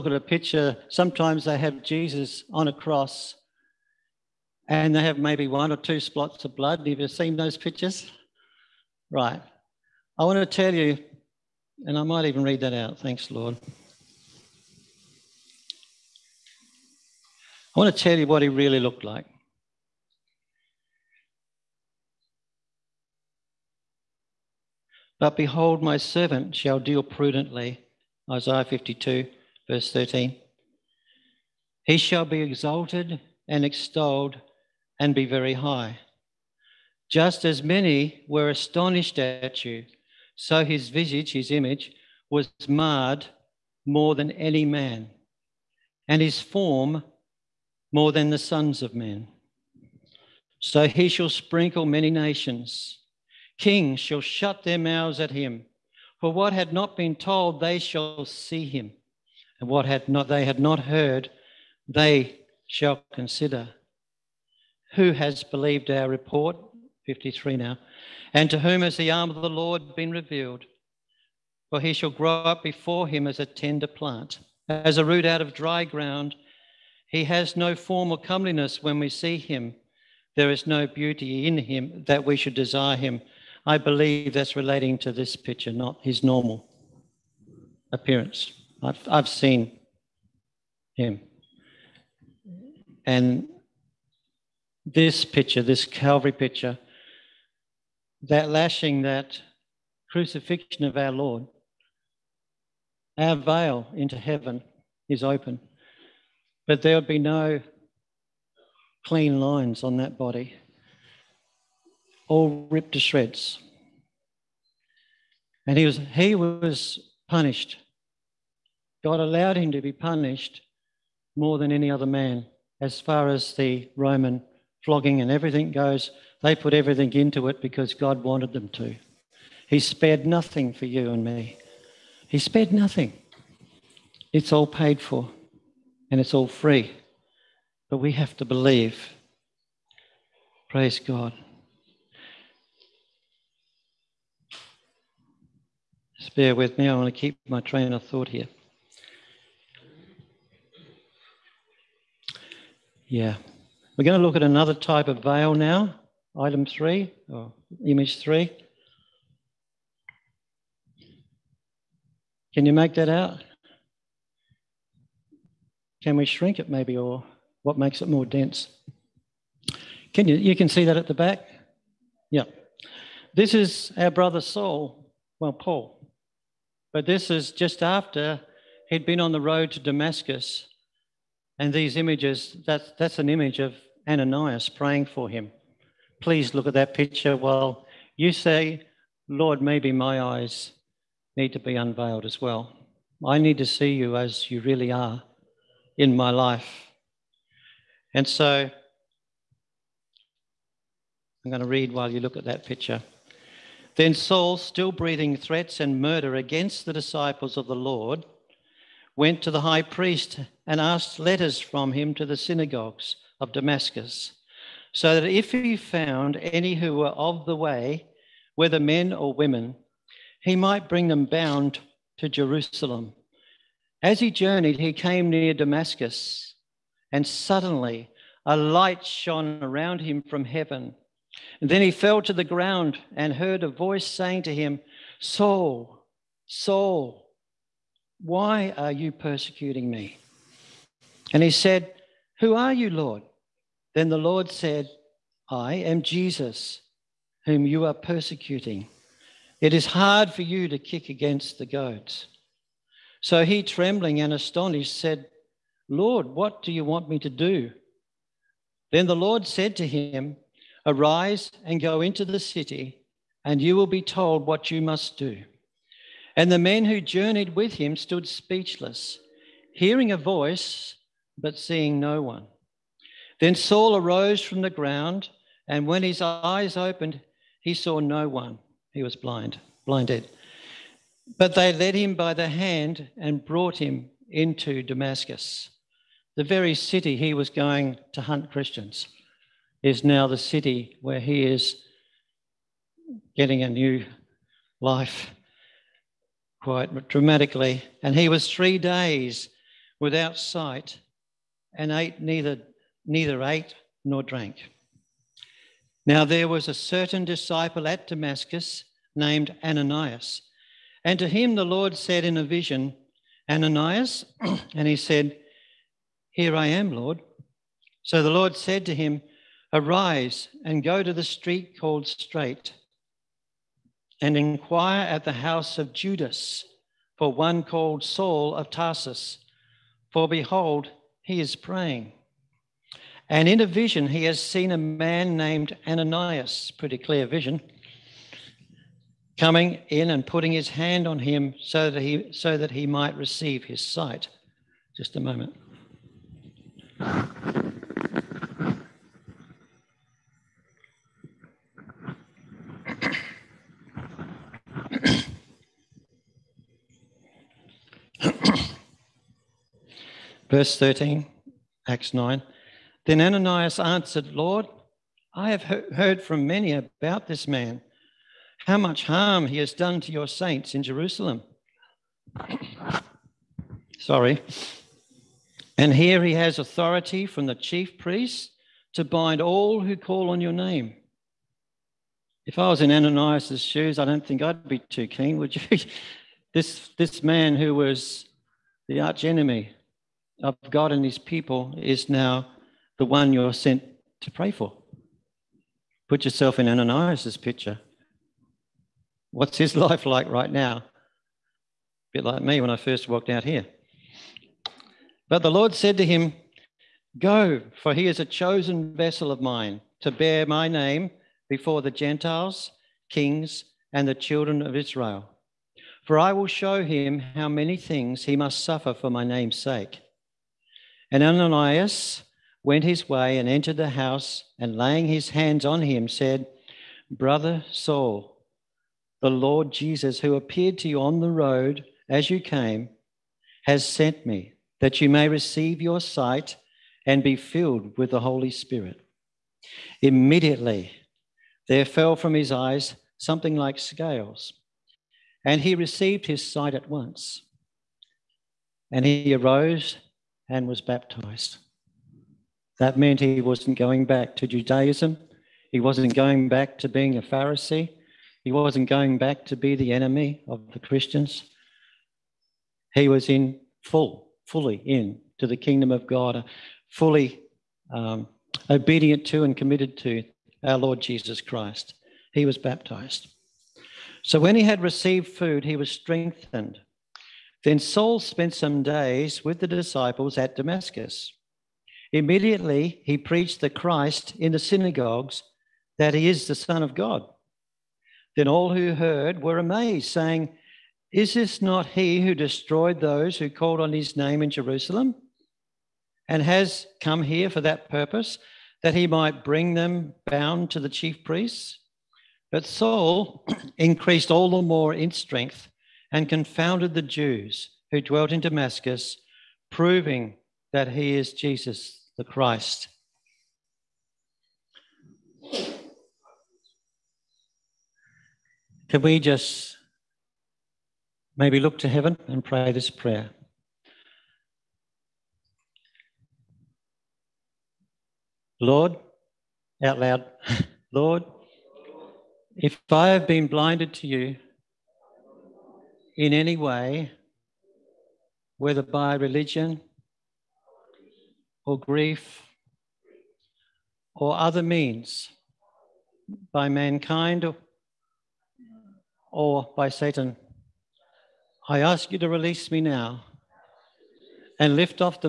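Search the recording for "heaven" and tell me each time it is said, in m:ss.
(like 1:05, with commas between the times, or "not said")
1:44, 3:50, 8:41.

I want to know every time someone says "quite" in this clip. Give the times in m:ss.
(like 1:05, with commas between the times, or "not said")
4:56.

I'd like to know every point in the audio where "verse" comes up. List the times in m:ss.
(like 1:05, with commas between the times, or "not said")
0:29, 6:00.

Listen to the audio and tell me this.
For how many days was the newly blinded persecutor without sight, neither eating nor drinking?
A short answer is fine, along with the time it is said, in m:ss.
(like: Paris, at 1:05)
3, at 4:58.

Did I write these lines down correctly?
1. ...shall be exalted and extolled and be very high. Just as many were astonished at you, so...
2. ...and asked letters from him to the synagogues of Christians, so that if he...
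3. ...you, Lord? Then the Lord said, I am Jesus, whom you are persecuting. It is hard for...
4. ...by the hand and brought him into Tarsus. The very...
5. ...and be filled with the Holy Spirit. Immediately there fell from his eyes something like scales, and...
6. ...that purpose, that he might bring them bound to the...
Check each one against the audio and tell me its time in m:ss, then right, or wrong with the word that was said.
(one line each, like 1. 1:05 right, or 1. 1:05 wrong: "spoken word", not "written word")
1. 0:31 right
2. 3:30 wrong: "Damascus", not "Christians"
3. 4:02 right
4. 4:42 wrong: "Damascus", not "Tarsus"
5. 7:17 right
6. 8:17 right.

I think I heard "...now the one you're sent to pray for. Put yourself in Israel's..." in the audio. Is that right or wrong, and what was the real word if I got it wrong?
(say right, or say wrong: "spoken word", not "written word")
wrong: "Ananias", not "Israel".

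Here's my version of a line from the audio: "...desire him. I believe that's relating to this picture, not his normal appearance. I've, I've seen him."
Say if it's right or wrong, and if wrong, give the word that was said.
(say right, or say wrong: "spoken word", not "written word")
right.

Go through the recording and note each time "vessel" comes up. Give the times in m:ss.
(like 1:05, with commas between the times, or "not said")
6:48.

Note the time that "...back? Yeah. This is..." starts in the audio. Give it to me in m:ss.
2:51.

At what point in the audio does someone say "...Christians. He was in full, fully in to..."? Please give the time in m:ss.
7:40.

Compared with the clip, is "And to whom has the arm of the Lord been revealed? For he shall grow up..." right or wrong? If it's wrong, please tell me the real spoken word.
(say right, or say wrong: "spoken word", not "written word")
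right.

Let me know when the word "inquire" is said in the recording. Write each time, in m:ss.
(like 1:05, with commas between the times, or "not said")
5:24.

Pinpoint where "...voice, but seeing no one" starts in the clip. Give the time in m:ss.
4:30.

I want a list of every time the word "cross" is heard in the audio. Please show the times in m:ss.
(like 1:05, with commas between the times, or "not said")
0:02.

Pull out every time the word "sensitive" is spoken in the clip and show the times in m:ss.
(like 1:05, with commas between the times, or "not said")
not said.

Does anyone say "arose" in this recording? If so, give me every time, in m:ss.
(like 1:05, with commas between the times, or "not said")
4:33, 7:29.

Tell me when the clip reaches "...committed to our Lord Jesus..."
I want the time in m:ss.
7:49.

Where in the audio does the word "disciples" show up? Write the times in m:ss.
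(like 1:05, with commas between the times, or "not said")
3:26, 5:07, 7:59.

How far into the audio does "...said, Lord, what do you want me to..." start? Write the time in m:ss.
4:14.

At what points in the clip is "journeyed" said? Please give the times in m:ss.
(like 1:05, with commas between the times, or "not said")
3:44, 4:26.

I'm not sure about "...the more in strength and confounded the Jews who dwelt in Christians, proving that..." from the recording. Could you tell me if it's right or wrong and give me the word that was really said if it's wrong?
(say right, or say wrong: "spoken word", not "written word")
wrong: "Damascus", not "Christians".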